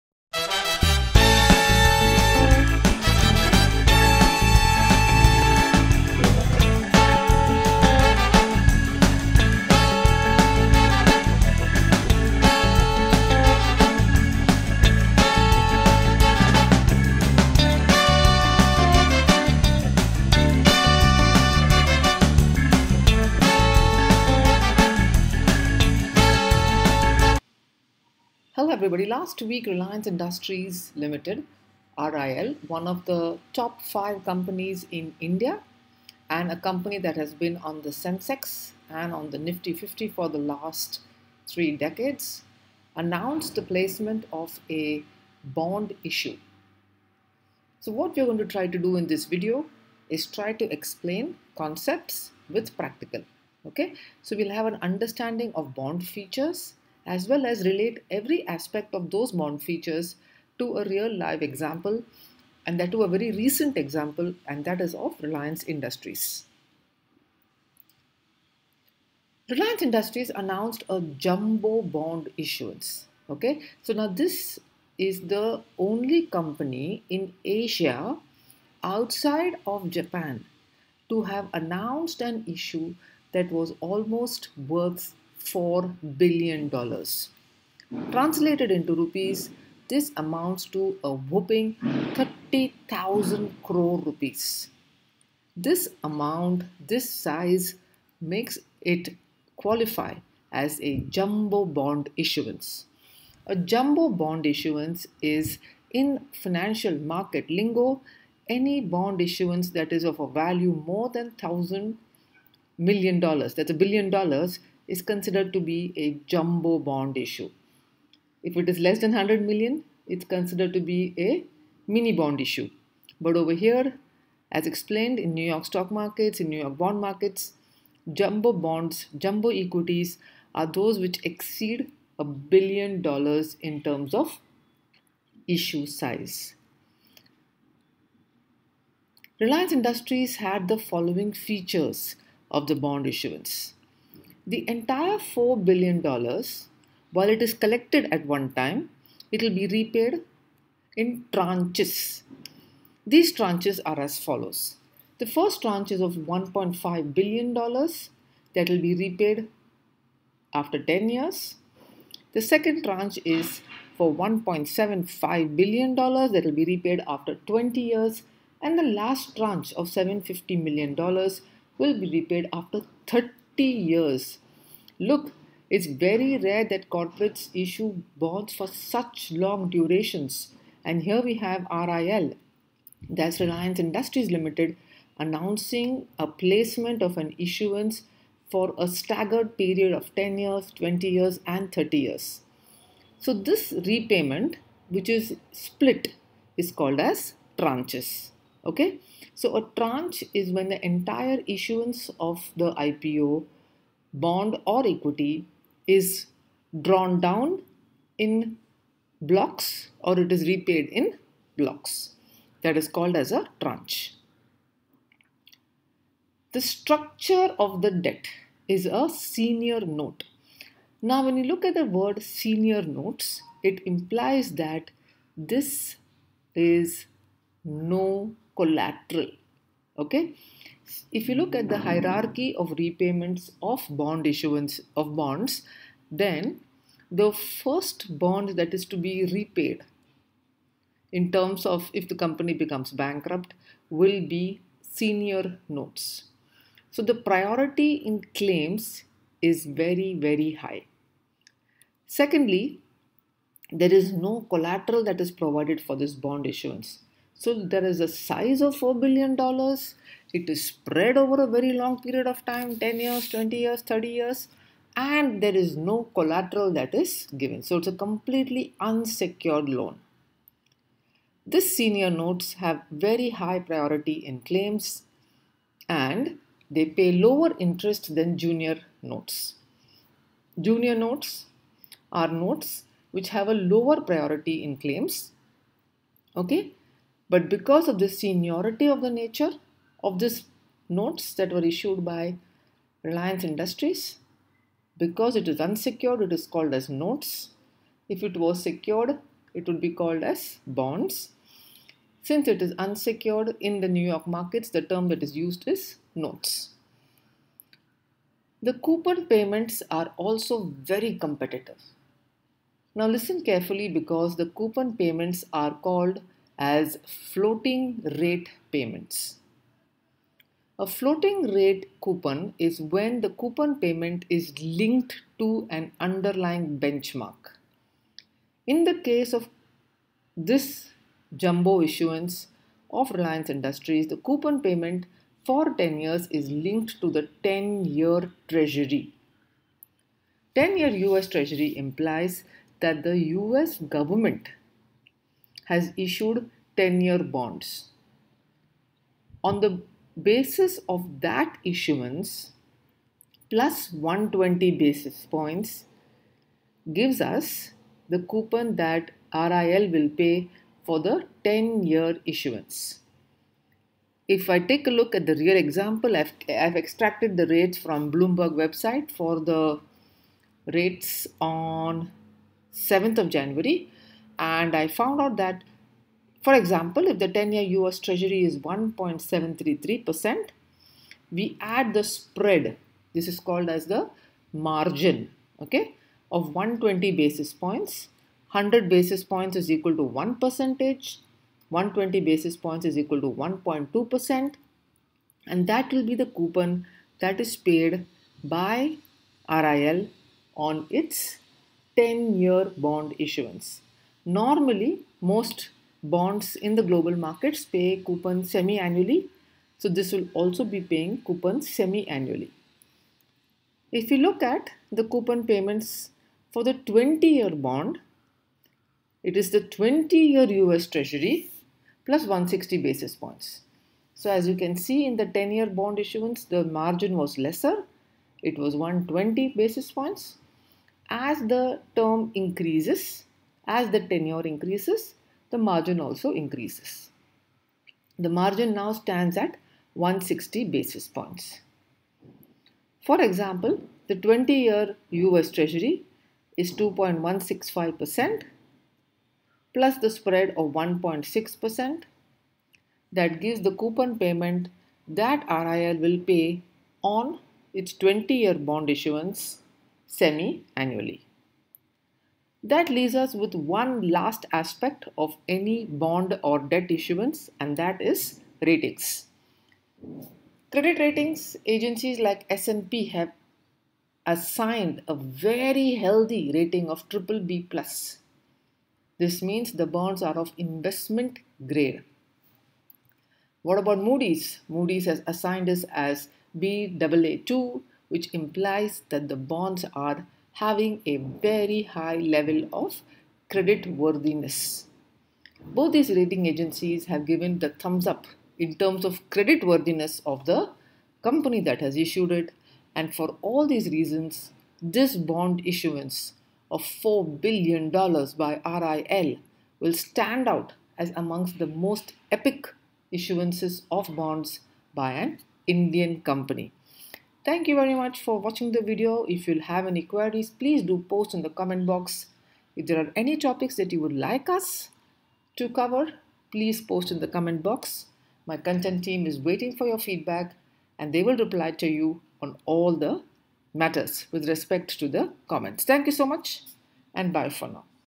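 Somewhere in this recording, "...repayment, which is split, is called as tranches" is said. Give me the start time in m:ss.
3:13.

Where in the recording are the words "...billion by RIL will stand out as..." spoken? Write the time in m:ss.
8:27.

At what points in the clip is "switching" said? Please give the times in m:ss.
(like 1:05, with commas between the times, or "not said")
not said.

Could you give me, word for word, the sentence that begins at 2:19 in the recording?
Reliance Industries had the following features of the bond issuance.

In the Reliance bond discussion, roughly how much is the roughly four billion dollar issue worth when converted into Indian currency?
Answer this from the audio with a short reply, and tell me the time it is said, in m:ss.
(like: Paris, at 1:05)
30,000 crore rupees, at 1:32.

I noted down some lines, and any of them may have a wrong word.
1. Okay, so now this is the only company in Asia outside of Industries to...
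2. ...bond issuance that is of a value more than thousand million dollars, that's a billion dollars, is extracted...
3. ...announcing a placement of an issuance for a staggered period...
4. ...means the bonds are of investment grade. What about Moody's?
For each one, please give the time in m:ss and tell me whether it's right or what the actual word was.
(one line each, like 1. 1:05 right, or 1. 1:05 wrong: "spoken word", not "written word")
1. 1:13 wrong: "Japan", not "Industries"
2. 1:48 wrong: "considered", not "extracted"
3. 3:05 right
4. 7:59 right.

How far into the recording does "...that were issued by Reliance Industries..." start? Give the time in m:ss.
4:51.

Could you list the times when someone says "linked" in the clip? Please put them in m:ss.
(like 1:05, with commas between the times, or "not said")
5:24, 5:36.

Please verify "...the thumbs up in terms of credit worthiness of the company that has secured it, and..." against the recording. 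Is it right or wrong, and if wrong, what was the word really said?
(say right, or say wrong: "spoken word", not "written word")
wrong: "issued", not "secured".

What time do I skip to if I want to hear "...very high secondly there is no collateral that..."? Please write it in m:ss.
4:10.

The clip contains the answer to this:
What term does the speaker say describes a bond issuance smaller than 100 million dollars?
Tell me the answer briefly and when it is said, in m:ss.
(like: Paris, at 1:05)
mini bond issue, at 2:01.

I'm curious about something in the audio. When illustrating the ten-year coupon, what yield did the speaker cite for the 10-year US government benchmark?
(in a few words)
1.733%.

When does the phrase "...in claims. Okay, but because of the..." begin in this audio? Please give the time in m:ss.
4:44.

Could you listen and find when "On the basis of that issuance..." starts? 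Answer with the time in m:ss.
5:49.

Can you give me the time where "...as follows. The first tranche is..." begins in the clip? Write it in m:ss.
2:33.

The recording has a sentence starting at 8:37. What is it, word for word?
Thank you very much for watching the video.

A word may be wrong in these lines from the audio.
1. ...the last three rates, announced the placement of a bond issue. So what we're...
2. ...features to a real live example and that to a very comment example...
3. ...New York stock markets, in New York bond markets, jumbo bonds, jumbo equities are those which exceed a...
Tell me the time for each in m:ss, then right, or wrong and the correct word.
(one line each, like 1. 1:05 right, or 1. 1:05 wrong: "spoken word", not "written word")
1. 0:40 wrong: "decades", not "rates"
2. 0:59 wrong: "recent", not "comment"
3. 2:05 right.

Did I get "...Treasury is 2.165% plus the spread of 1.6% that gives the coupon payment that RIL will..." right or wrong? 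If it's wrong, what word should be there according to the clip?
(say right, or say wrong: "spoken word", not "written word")
right.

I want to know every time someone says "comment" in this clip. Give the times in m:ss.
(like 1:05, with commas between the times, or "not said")
8:41, 8:47, 8:55.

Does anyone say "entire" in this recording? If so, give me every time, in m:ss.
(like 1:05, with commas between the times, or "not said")
2:24, 3:20.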